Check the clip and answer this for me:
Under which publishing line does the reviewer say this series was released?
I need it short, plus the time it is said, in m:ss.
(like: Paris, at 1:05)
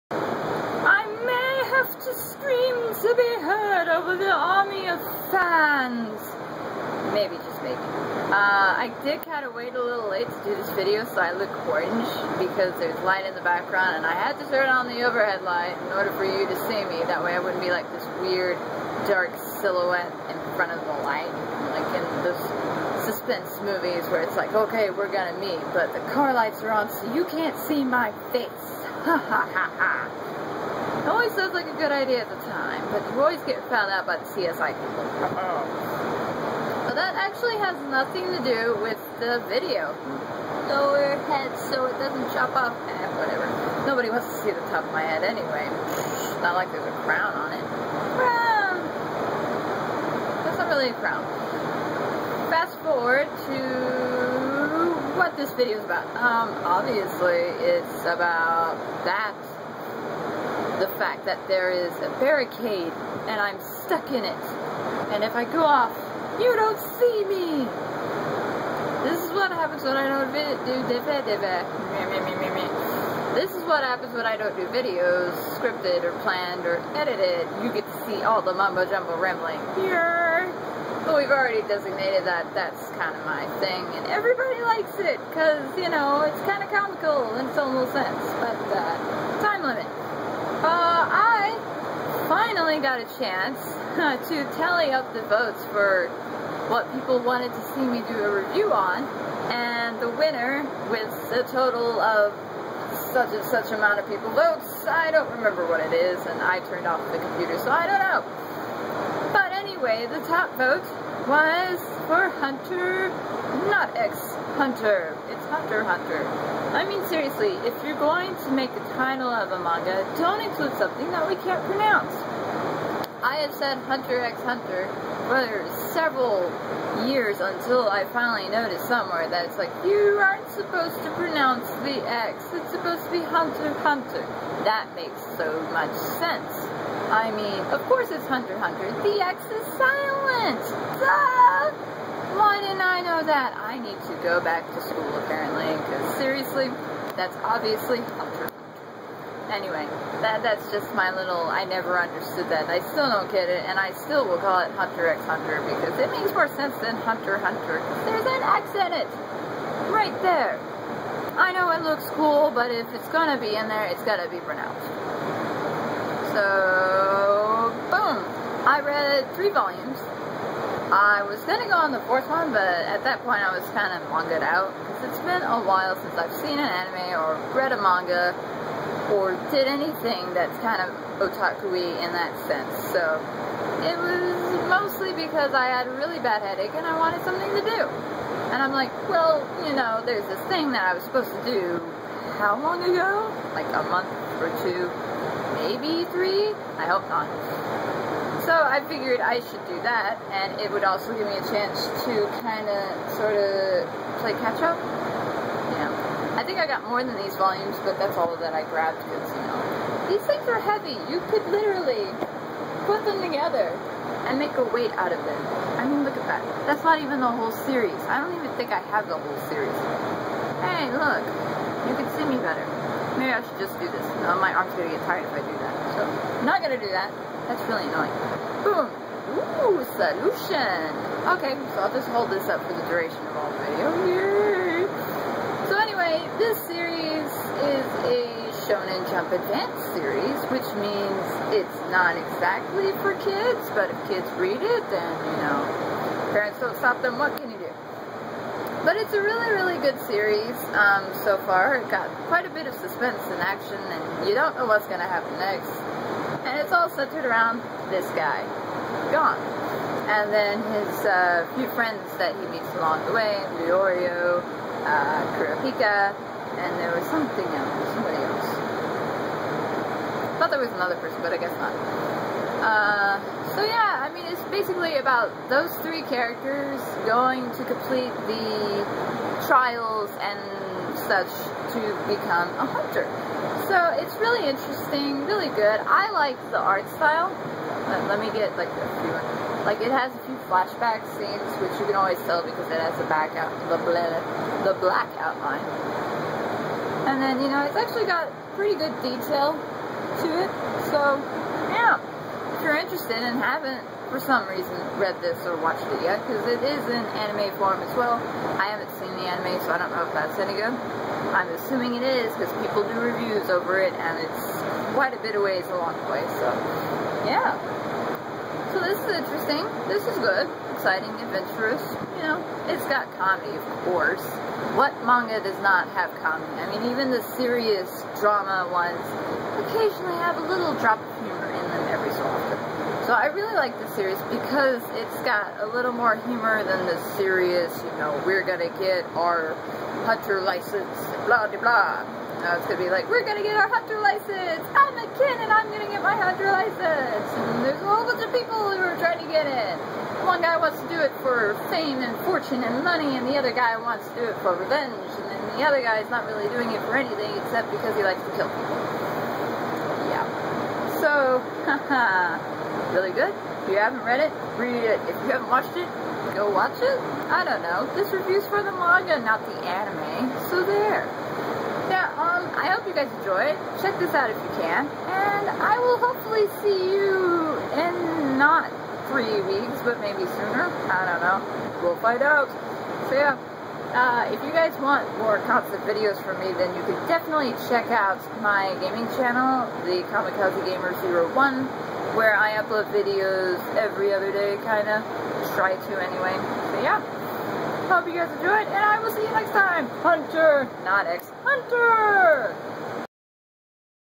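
Shonen Jump Advanced, at 3:58.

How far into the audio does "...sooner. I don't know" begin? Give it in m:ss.
6:20.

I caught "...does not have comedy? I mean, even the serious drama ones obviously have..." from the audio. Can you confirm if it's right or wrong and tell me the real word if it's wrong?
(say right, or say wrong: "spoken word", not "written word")
wrong: "occasionally", not "obviously".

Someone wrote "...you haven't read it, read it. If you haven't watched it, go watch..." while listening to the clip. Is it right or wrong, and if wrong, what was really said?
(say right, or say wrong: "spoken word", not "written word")
right.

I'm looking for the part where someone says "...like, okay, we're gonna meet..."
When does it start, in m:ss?
0:24.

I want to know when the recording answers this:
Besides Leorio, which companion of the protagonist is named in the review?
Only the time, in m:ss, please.
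4:25.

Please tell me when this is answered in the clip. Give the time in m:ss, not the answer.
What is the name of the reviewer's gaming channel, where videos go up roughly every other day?
6:30.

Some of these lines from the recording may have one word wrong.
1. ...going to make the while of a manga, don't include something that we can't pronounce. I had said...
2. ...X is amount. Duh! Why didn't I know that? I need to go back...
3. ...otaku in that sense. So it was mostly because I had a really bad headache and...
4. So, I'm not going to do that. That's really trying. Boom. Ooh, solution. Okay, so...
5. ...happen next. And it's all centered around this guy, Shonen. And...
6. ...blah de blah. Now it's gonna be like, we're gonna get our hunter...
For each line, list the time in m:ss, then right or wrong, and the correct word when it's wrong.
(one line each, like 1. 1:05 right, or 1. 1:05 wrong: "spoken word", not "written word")
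1. 1:57 wrong: "title", not "while"
2. 2:19 wrong: "silent", not "amount"
3. 3:01 right
4. 3:45 wrong: "annoying", not "trying"
5. 4:15 wrong: "Gon", not "Shonen"
6. 5:41 right.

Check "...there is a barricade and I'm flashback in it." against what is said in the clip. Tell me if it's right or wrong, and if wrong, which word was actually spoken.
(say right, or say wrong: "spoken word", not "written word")
wrong: "stuck", not "flashback".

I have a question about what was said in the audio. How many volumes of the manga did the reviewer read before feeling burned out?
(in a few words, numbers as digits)
3.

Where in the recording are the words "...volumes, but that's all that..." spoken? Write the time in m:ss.
3:27.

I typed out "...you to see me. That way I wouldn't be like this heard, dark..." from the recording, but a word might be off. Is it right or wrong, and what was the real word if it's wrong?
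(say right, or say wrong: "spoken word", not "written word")
wrong: "weird", not "heard".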